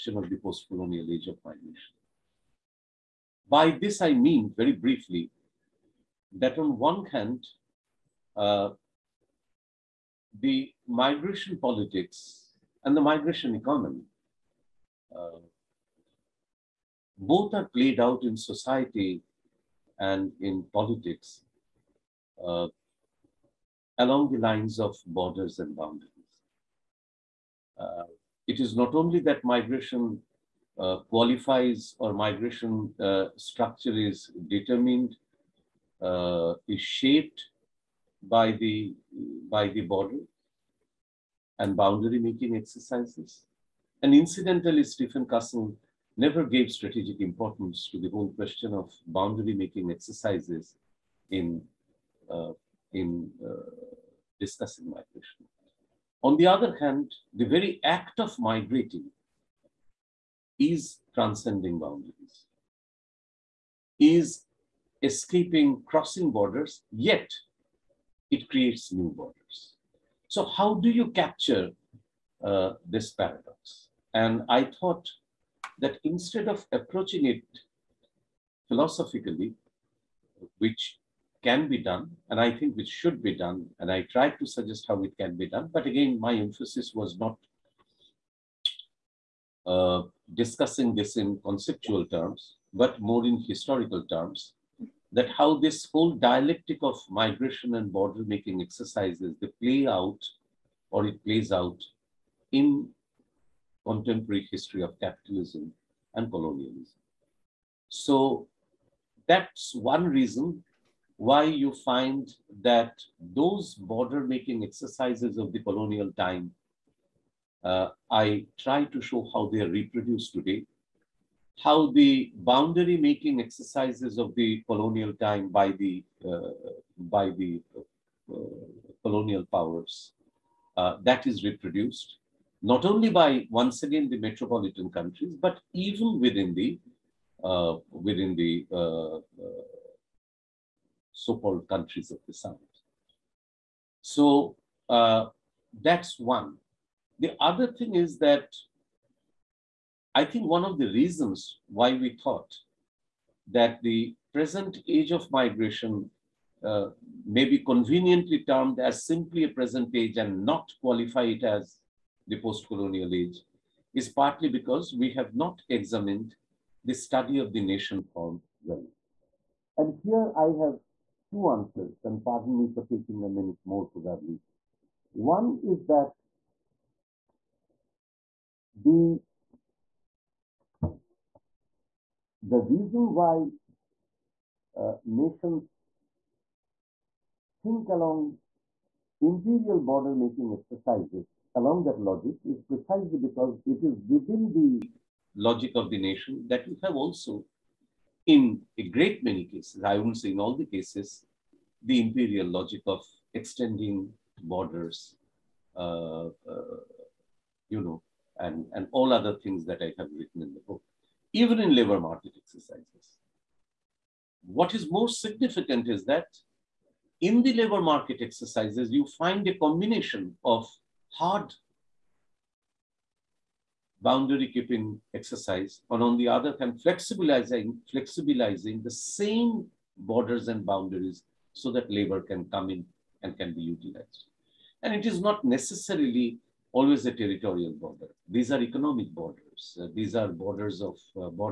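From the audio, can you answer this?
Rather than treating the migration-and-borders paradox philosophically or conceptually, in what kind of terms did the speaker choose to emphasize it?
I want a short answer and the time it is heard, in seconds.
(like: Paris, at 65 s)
historical terms, at 93 s.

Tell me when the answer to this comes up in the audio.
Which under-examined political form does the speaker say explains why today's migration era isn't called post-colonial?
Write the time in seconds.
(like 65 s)
167 s.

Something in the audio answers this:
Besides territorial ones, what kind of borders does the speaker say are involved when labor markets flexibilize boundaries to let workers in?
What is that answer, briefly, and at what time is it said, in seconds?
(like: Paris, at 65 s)
economic borders, at 238 s.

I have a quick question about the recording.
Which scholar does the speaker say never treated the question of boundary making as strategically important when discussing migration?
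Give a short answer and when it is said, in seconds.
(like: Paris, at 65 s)
Stephen Castle, at 44 s.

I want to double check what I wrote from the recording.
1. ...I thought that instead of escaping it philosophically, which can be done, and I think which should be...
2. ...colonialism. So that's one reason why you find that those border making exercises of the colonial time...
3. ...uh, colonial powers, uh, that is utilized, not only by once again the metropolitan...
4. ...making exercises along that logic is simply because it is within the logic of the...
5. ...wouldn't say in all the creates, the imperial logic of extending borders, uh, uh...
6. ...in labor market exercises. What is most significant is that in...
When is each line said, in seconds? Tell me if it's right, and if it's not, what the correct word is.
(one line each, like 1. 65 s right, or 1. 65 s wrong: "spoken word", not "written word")
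1. 74 s wrong: "approaching", not "escaping"
2. 106 s right
3. 128 s wrong: "reproduced", not "utilized"
4. 190 s wrong: "precisely", not "simply"
5. 199 s wrong: "cases", not "creates"
6. 211 s right.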